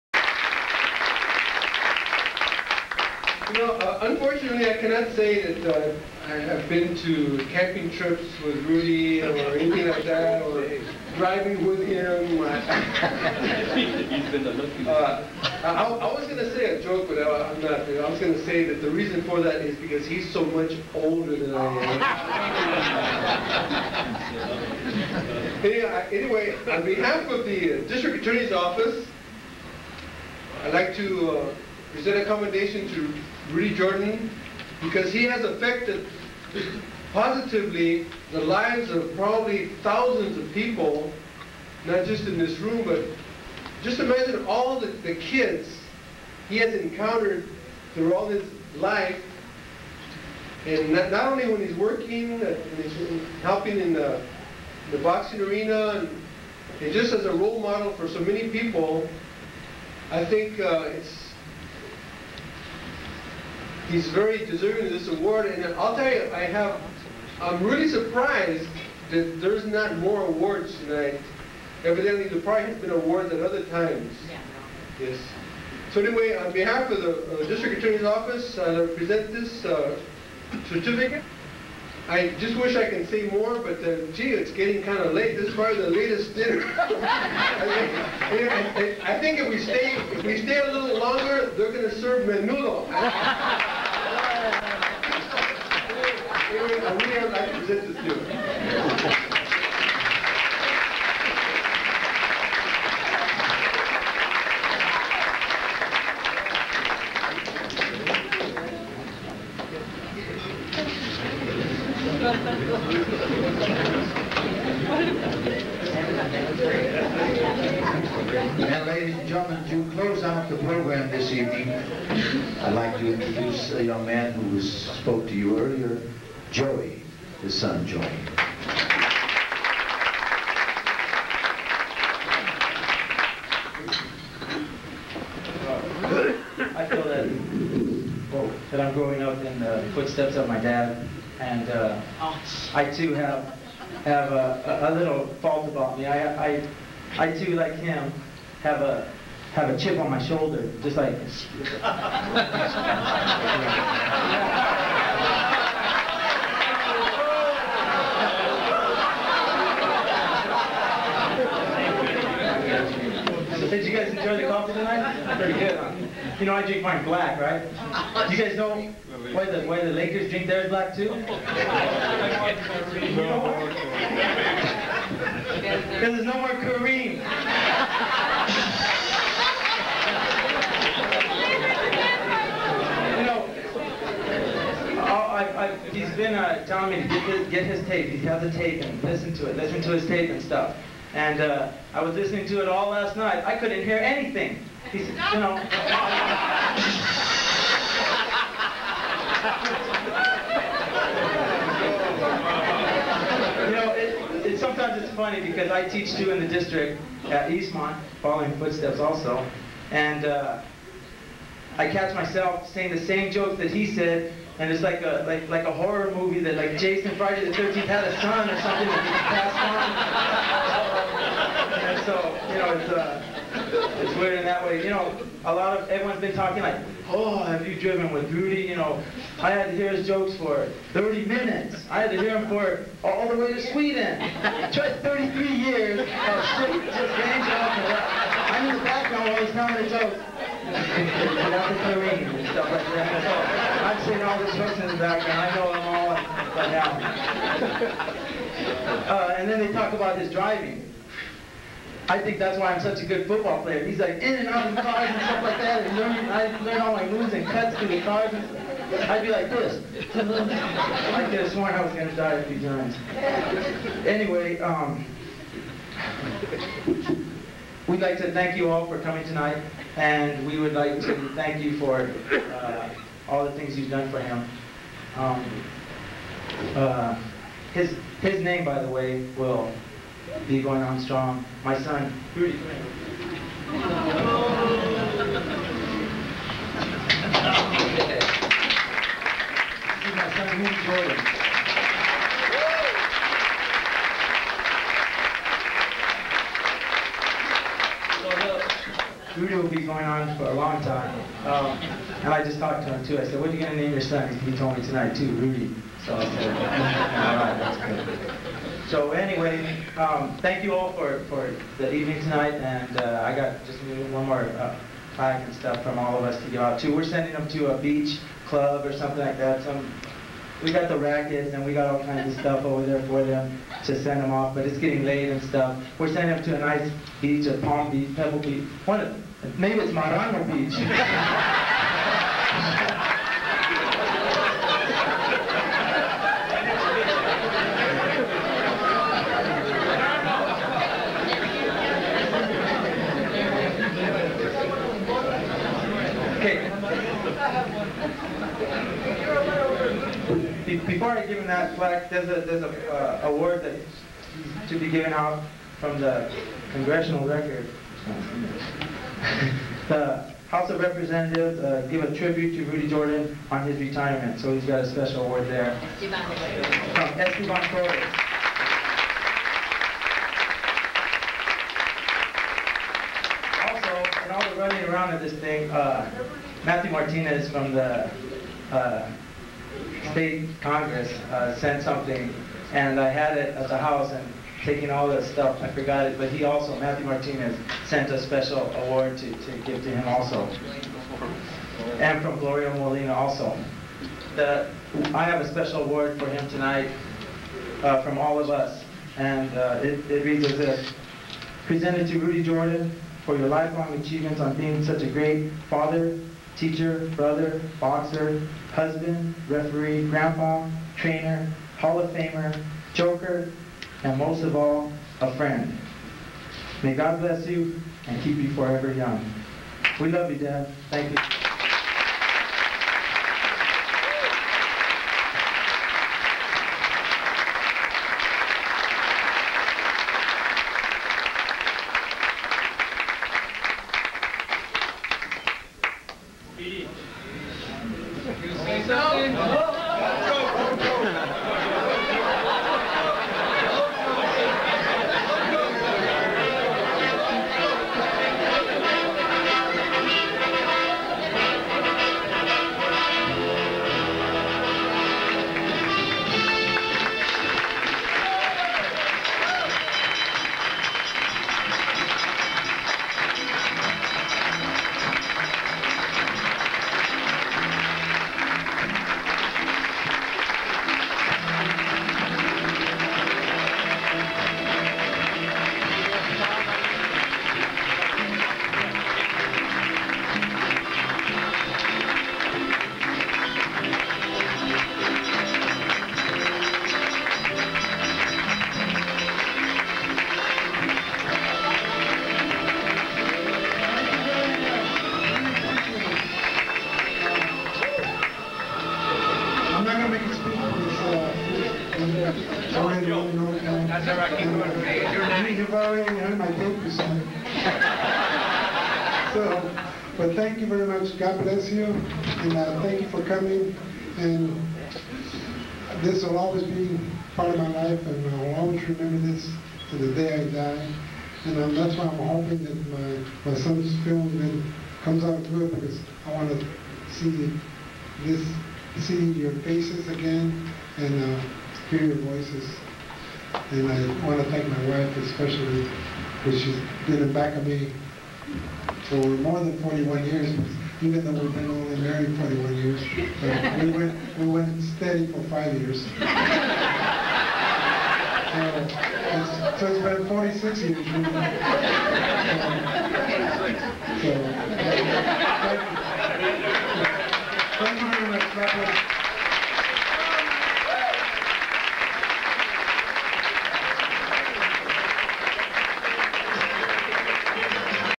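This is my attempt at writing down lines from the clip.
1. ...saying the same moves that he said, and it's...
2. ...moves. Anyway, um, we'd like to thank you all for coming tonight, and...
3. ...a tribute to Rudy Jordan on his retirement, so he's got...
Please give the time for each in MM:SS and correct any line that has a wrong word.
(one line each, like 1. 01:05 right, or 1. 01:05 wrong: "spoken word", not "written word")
1. 03:32 wrong: "jokes", not "moves"
2. 04:22 wrong: "times", not "moves"
3. 06:02 right.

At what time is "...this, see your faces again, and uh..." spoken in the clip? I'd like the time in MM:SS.
08:48.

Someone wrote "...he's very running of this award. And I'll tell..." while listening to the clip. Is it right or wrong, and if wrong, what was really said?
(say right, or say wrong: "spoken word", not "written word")
wrong: "deserving", not "running".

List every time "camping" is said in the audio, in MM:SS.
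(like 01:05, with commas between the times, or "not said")
00:07.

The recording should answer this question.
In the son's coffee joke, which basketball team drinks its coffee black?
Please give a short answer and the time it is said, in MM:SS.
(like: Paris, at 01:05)
Lakers, at 02:49.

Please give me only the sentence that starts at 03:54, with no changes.
Tried 33 years of shit just games off I'm in the background while he's telling the jokes.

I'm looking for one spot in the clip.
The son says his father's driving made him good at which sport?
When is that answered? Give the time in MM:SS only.
04:13.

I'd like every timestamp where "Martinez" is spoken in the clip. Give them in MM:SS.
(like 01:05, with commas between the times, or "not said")
06:16, 06:27.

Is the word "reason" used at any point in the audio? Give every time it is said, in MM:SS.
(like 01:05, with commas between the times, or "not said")
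00:18.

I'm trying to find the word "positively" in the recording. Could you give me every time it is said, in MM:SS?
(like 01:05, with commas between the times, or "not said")
00:37.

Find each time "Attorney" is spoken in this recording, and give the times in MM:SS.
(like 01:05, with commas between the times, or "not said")
00:28, 01:17.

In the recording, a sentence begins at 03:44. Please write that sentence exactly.
You know, a lot of, everyone's been talking like, oh, have you driven with Rudy?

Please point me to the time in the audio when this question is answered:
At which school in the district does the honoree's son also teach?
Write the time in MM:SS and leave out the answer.
03:27.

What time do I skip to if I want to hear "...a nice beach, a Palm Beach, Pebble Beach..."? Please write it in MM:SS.
05:26.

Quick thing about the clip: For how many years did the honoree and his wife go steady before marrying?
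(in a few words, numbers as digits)
5.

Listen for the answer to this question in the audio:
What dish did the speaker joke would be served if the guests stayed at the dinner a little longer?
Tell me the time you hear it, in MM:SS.
01:32.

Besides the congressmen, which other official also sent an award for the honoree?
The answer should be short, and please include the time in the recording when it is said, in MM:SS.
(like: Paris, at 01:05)
Gloria Molina, at 06:32.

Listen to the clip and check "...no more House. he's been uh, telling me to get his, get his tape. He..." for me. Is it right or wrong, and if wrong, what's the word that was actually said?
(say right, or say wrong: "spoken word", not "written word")
wrong: "Kareem", not "House".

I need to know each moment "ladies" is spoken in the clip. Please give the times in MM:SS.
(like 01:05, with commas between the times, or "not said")
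01:58.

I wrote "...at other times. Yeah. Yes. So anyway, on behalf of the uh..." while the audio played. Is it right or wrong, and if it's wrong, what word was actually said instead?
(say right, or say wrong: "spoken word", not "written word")
right.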